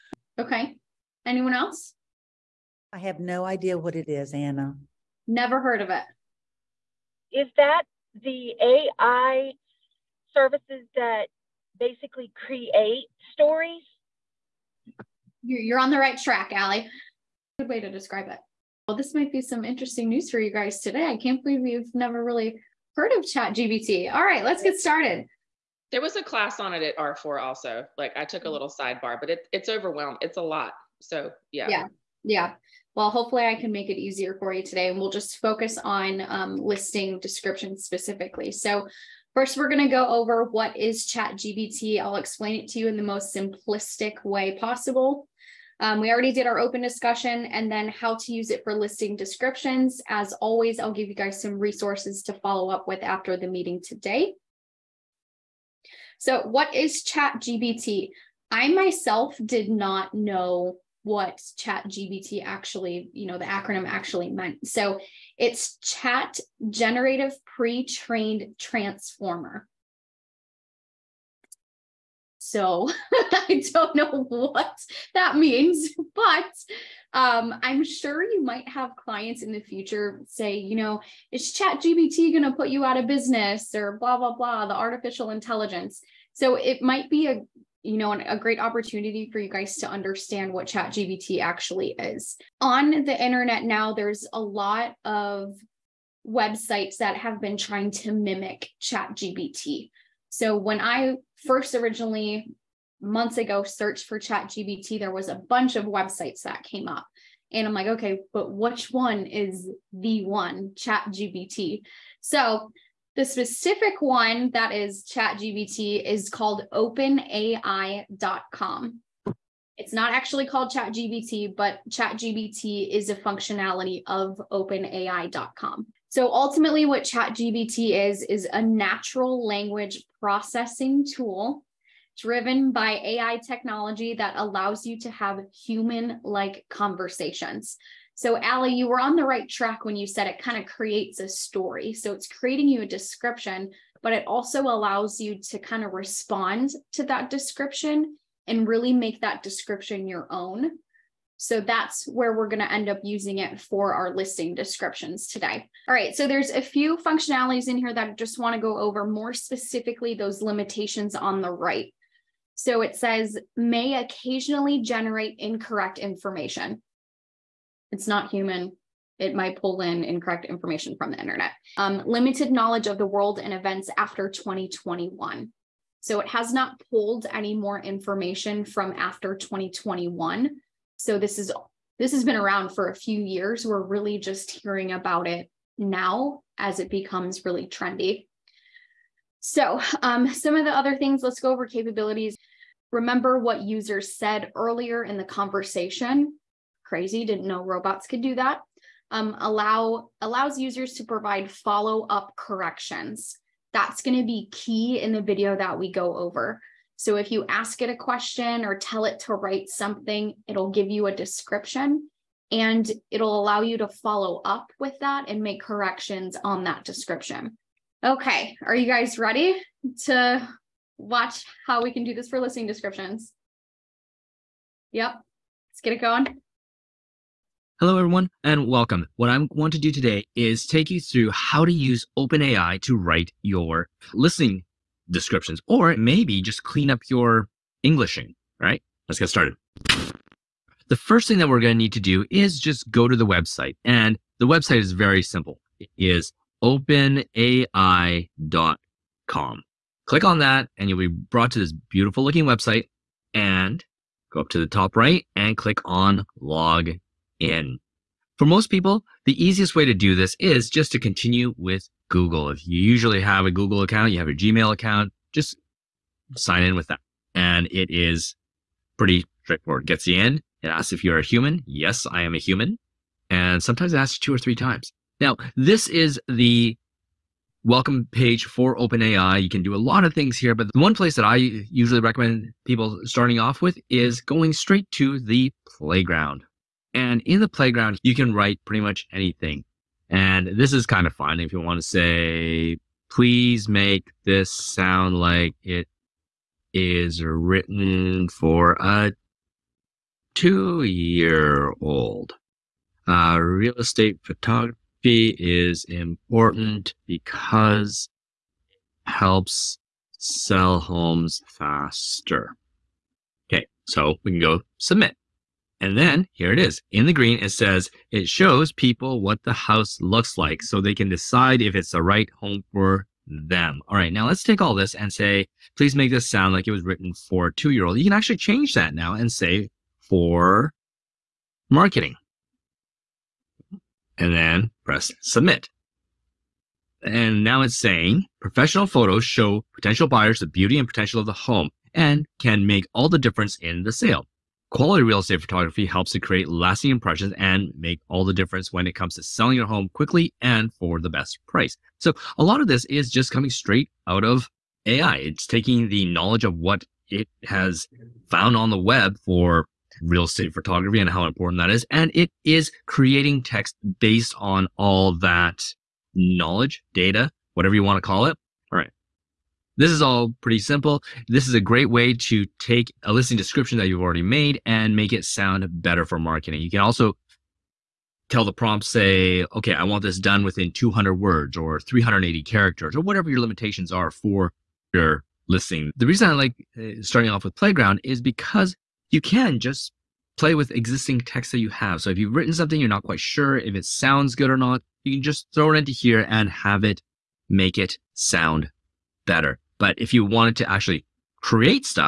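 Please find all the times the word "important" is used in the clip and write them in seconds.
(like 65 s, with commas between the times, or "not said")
305 s, 361 s.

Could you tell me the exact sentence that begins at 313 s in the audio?
Okay, so we can go submit.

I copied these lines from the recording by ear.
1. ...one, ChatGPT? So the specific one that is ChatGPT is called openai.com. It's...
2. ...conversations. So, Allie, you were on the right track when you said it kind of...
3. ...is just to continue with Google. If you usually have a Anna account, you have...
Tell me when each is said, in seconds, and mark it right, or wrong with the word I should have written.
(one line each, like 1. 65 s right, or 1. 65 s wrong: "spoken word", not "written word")
1. 110 s right
2. 136 s right
3. 260 s wrong: "Google", not "Anna".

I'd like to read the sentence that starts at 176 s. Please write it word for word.
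So it has not pulled any more information from after 2021.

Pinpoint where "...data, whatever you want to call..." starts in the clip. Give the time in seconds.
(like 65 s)
366 s.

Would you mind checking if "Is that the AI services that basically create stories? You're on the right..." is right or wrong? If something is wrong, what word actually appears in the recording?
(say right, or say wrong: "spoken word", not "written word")
right.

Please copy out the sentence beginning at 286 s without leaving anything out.
And in the playground, you can write pretty much anything.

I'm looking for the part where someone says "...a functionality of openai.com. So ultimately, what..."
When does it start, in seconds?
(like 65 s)
123 s.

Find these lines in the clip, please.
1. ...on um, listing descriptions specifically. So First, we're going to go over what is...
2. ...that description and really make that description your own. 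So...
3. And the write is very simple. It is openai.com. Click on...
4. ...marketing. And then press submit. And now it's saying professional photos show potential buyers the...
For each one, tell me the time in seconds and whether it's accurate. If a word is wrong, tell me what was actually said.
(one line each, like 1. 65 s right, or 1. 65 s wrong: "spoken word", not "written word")
1. 35 s right
2. 147 s right
3. 243 s wrong: "website", not "write"
4. 331 s right.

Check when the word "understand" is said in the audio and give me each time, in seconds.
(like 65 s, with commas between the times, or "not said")
89 s.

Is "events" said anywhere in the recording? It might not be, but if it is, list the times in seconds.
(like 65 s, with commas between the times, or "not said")
173 s.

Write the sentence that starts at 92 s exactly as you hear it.
On the internet now, there's a lot of websites that have been trying to mimic ChatGPT.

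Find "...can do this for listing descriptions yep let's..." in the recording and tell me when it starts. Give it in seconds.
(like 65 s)
221 s.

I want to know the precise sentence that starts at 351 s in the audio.
So, a lot of this is just coming straight out of AI.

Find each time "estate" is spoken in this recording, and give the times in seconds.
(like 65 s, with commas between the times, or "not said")
303 s, 345 s, 360 s.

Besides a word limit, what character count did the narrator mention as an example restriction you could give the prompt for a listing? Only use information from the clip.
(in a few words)
380 characters.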